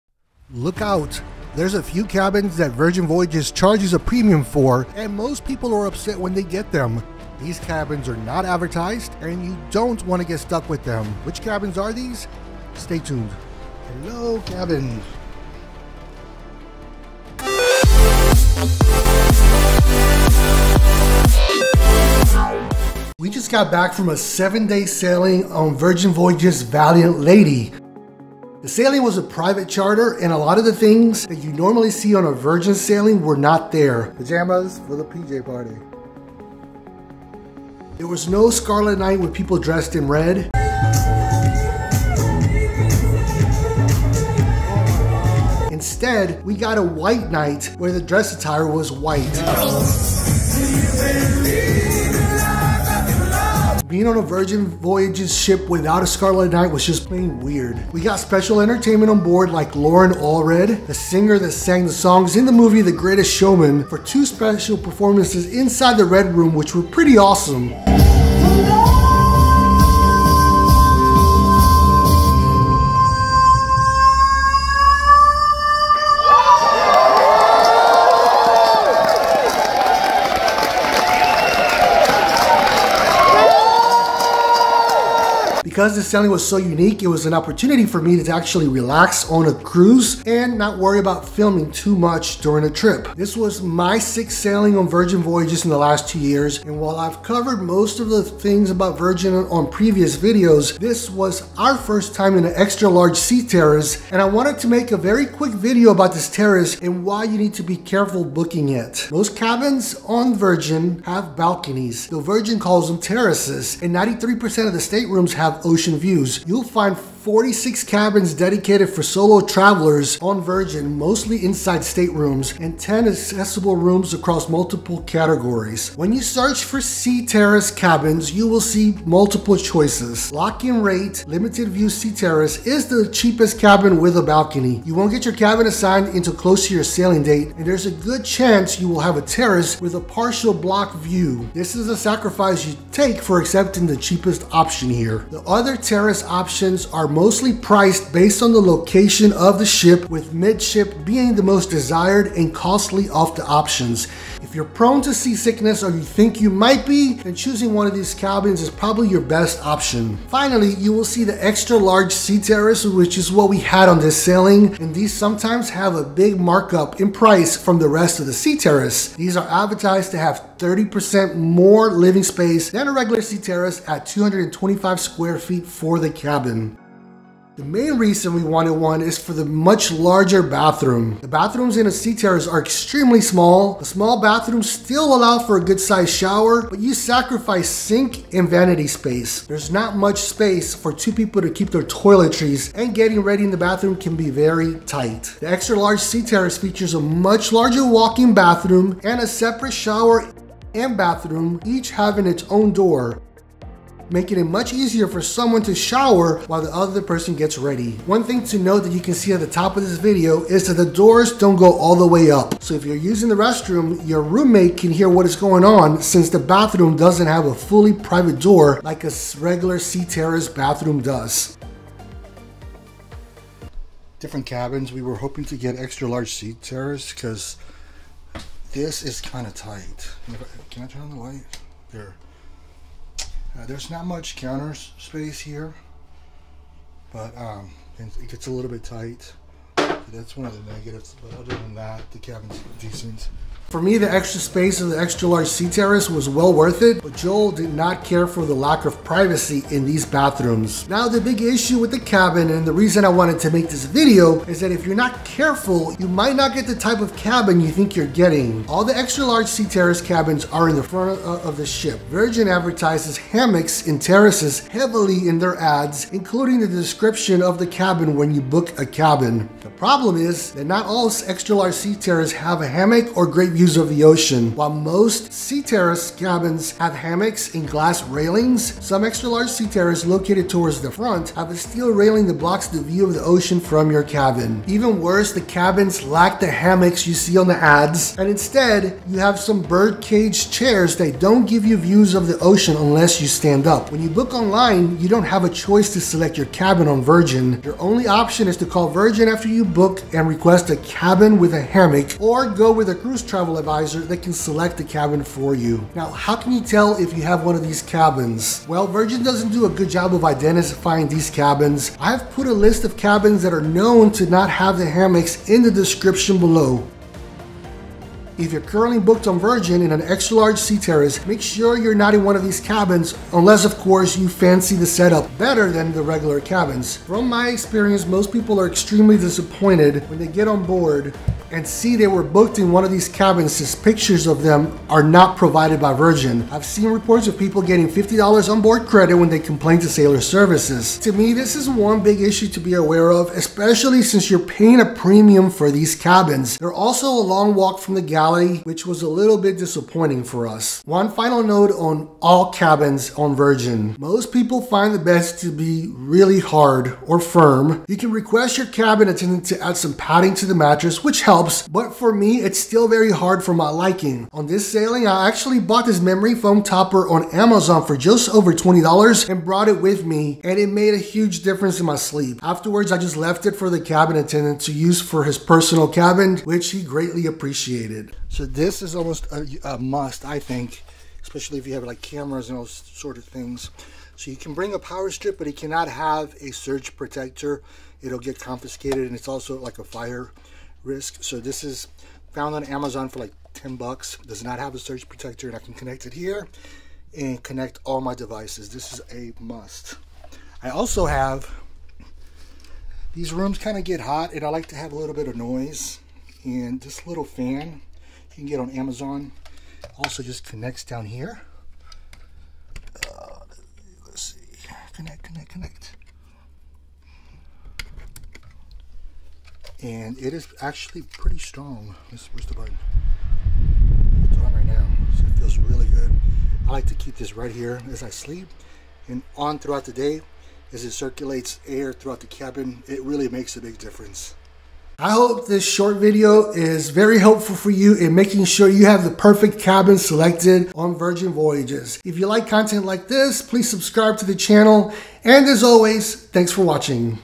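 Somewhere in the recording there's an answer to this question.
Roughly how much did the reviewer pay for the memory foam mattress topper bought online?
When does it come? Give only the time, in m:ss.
6:07.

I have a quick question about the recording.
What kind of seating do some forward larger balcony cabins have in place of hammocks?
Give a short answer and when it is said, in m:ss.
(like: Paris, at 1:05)
Birdcage chairs, at 4:49.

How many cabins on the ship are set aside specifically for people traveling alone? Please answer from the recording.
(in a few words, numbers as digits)
46.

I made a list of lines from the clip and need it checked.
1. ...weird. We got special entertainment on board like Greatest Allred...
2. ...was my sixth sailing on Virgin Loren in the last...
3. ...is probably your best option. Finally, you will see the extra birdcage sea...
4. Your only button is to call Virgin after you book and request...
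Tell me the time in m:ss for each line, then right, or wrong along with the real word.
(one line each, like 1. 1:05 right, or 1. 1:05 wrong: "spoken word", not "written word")
1. 0:57 wrong: "Loren", not "Greatest"
2. 1:33 wrong: "Voyages", not "Loren"
3. 2:38 wrong: "large", not "birdcage"
4. 4:57 wrong: "option", not "button".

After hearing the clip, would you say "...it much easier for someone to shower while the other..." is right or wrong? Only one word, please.
right.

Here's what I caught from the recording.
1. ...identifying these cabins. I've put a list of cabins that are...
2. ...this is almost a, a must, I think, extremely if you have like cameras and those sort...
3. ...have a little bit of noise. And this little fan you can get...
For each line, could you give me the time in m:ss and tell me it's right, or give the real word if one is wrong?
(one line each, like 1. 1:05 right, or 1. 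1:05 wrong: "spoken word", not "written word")
1. 5:10 right
2. 6:18 wrong: "especially", not "extremely"
3. 6:44 right.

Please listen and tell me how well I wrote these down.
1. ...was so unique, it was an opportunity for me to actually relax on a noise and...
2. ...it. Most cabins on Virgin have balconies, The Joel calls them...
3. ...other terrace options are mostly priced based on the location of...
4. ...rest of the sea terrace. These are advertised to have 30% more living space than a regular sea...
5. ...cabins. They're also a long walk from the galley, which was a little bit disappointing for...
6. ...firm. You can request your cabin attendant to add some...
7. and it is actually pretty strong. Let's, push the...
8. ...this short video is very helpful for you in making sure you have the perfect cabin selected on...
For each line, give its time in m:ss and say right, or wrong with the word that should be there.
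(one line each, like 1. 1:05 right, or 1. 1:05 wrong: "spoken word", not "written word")
1. 1:26 wrong: "cruise", not "noise"
2. 1:48 wrong: "Virgin", not "Joel"
3. 2:25 right
4. 2:47 right
5. 5:45 right
6. 5:57 right
7. 6:59 right
8. 7:15 right.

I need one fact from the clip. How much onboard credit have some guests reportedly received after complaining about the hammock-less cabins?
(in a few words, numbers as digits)
$50.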